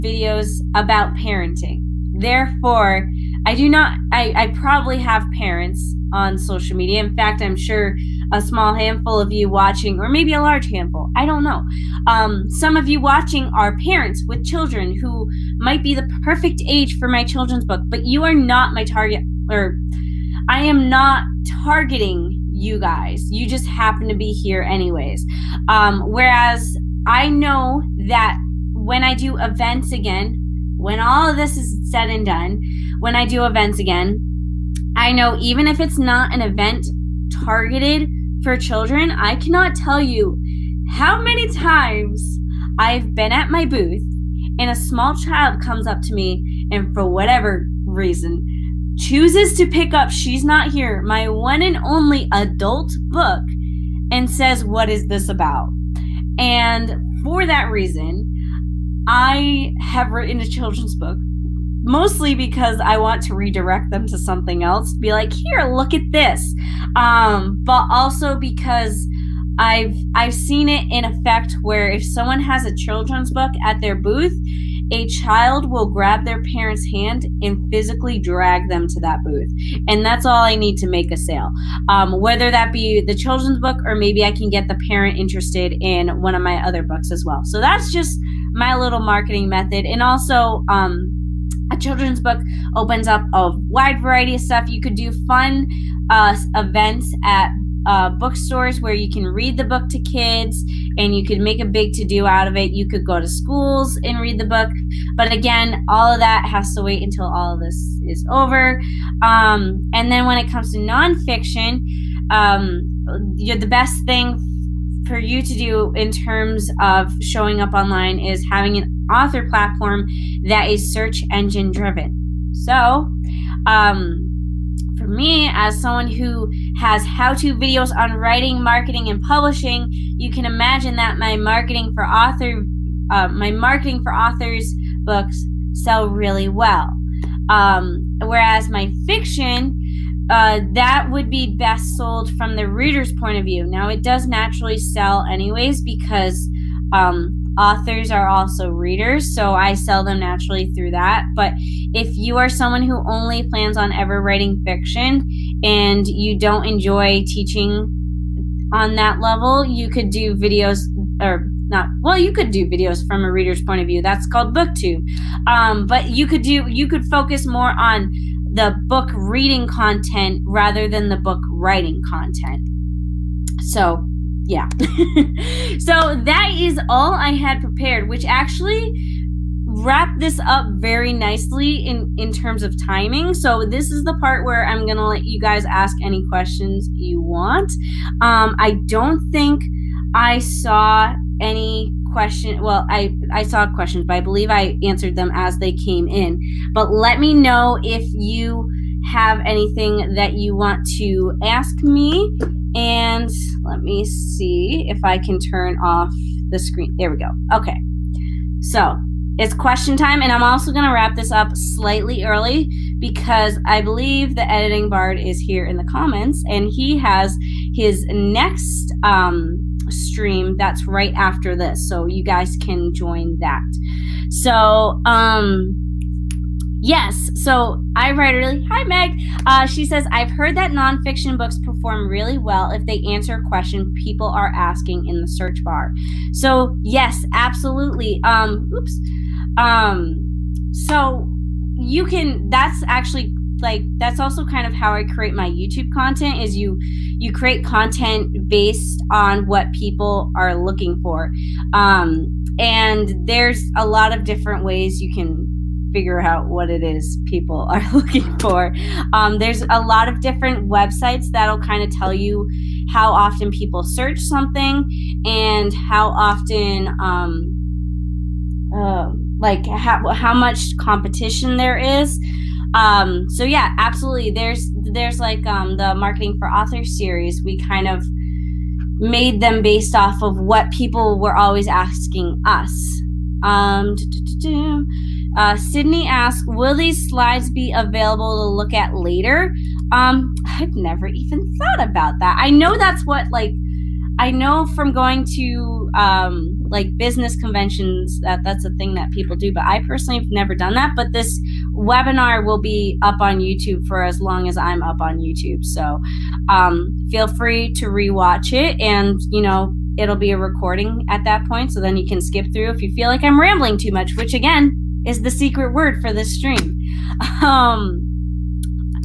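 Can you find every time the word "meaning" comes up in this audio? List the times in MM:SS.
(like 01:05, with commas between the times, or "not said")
not said.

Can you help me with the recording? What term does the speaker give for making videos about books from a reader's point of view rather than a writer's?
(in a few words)
booktube.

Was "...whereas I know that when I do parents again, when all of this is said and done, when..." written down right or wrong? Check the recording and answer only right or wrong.
wrong.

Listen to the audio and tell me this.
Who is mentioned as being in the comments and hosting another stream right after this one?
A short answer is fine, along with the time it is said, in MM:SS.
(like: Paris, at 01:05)
the editing bard, at 03:34.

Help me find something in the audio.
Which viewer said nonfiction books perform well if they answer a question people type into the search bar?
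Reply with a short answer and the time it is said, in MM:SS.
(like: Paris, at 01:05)
Meg, at 03:48.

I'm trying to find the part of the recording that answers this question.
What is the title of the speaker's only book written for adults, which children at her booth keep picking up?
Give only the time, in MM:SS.
00:50.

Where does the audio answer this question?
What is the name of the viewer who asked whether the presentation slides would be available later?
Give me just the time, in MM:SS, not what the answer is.
04:45.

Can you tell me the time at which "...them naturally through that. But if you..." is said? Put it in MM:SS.
02:30.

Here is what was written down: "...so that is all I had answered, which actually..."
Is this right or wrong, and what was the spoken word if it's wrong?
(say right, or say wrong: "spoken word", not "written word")
wrong: "prepared", not "answered".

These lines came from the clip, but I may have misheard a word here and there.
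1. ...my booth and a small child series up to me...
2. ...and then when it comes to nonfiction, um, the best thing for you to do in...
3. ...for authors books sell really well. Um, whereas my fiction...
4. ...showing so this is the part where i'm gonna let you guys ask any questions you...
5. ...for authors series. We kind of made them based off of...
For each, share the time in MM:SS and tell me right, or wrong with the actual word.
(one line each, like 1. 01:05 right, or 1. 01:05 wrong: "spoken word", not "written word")
1. 00:43 wrong: "comes", not "series"
2. 01:49 right
3. 02:14 right
4. 03:02 wrong: "timing", not "showing"
5. 04:36 right.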